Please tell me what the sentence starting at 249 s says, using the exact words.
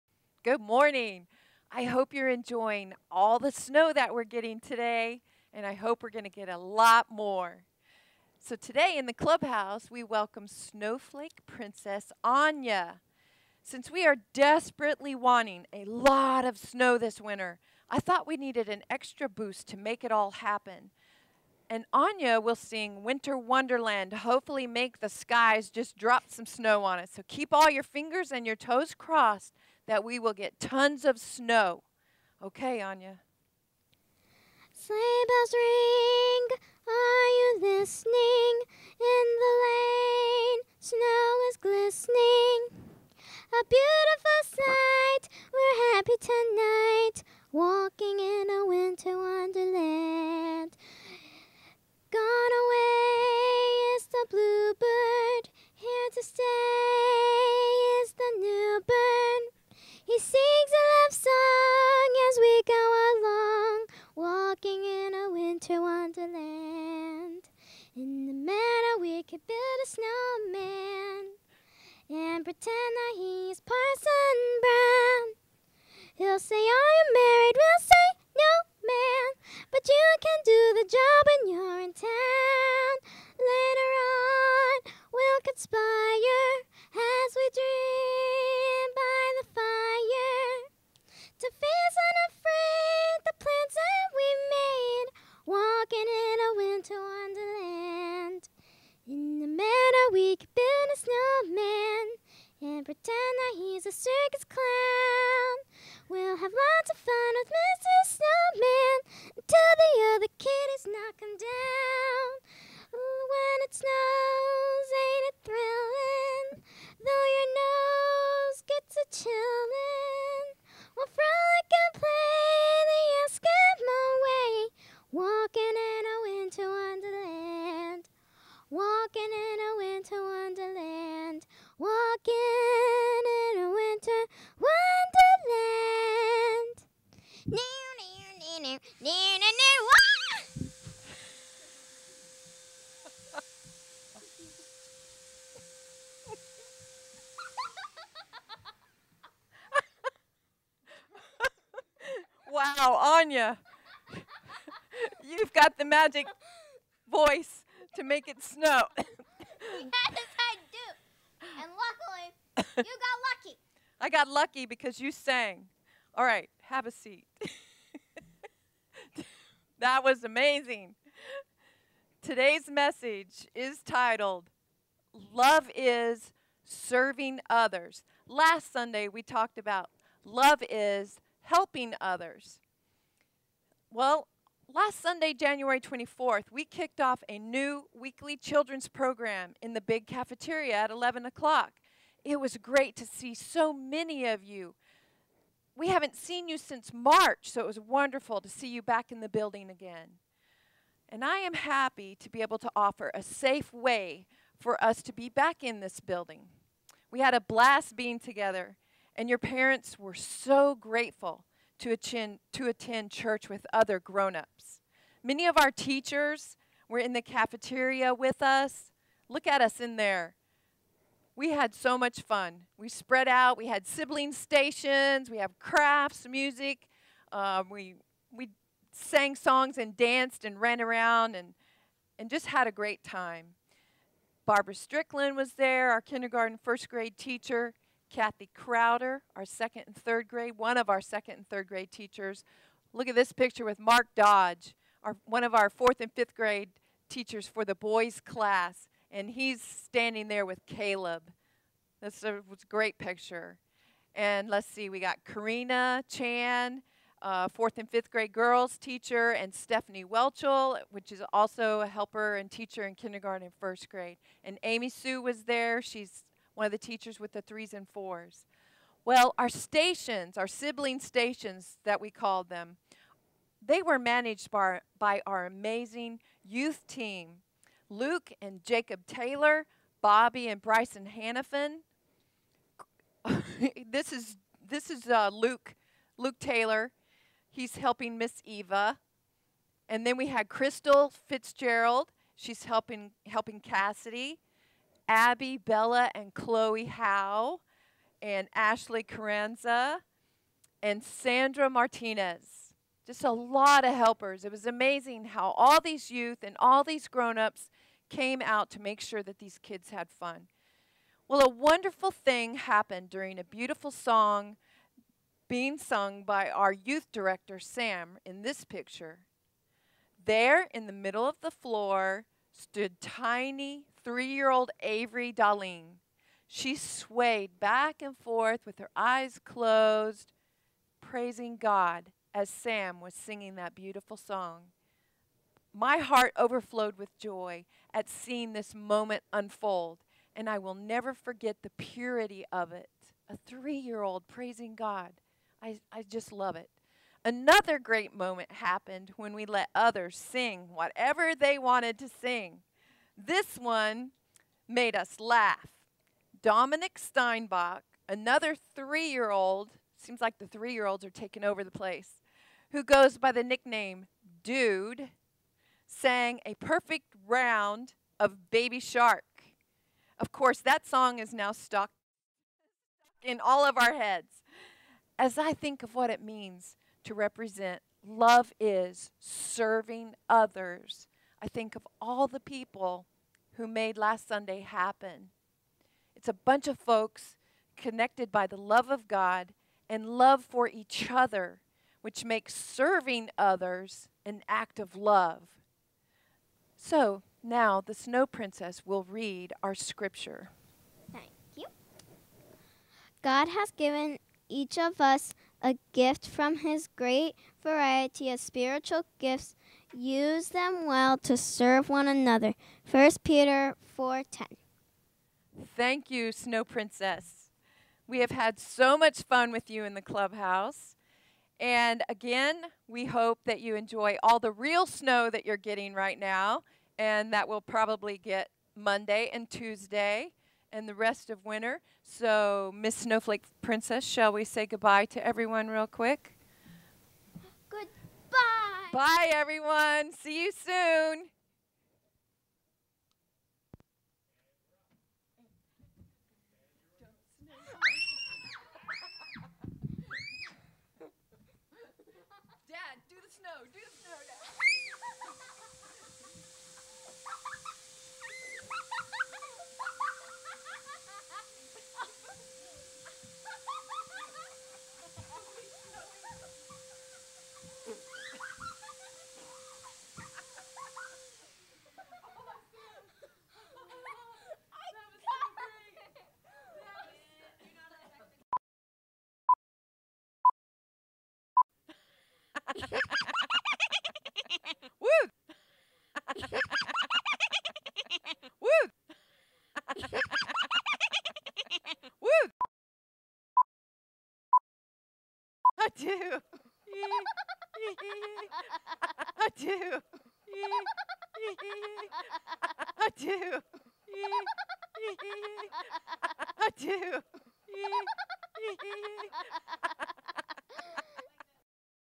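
And he's standing there with Caleb.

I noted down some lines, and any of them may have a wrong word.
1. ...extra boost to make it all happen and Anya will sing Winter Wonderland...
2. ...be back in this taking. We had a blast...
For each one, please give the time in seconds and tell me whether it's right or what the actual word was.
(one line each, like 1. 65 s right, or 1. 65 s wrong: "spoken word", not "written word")
1. 18 s right
2. 205 s wrong: "building", not "taking".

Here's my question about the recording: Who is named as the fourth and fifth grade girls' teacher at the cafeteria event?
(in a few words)
Karina Chan.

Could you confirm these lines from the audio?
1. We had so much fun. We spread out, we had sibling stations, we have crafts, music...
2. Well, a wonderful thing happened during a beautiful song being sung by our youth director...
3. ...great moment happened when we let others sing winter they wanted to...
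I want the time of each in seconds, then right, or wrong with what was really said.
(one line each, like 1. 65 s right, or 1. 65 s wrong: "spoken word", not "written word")
1. 221 s right
2. 311 s right
3. 347 s wrong: "whatever", not "winter".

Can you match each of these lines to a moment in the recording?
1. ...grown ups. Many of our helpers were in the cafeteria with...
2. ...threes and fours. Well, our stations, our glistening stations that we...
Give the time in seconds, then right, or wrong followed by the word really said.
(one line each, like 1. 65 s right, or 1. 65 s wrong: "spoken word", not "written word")
1. 213 s wrong: "teachers", not "helpers"
2. 267 s wrong: "sibling", not "glistening".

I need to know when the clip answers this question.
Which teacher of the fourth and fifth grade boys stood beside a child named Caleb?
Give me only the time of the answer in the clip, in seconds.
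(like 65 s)
243 s.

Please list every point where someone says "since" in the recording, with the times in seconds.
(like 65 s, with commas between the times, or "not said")
13 s, 196 s.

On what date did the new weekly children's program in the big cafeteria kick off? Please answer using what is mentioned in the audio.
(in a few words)
January 24th.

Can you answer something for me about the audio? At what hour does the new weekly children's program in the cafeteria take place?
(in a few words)
11 o'clock.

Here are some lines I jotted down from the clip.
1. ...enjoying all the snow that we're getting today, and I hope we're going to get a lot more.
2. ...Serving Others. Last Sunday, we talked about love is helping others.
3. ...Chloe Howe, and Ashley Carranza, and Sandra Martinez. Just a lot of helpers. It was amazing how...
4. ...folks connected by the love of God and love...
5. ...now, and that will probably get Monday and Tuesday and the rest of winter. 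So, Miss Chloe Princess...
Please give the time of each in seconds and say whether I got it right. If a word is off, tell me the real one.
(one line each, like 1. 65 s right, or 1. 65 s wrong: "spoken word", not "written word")
1. 2 s right
2. 176 s right
3. 296 s right
4. 386 s right
5. 426 s wrong: "Snowflake", not "Chloe".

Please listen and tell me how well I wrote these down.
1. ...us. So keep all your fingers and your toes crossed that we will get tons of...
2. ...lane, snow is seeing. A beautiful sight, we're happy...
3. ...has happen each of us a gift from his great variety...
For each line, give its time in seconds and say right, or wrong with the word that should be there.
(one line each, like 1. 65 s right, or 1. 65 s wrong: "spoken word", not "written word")
1. 26 s right
2. 39 s wrong: "glistening", not "seeing"
3. 403 s wrong: "given", not "happen".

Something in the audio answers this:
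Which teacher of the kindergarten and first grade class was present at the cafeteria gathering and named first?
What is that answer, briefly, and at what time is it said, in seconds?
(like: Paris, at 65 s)
Barbara Strickland, at 234 s.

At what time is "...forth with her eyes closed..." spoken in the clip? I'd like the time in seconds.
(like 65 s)
328 s.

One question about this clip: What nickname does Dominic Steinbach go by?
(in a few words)
Dude.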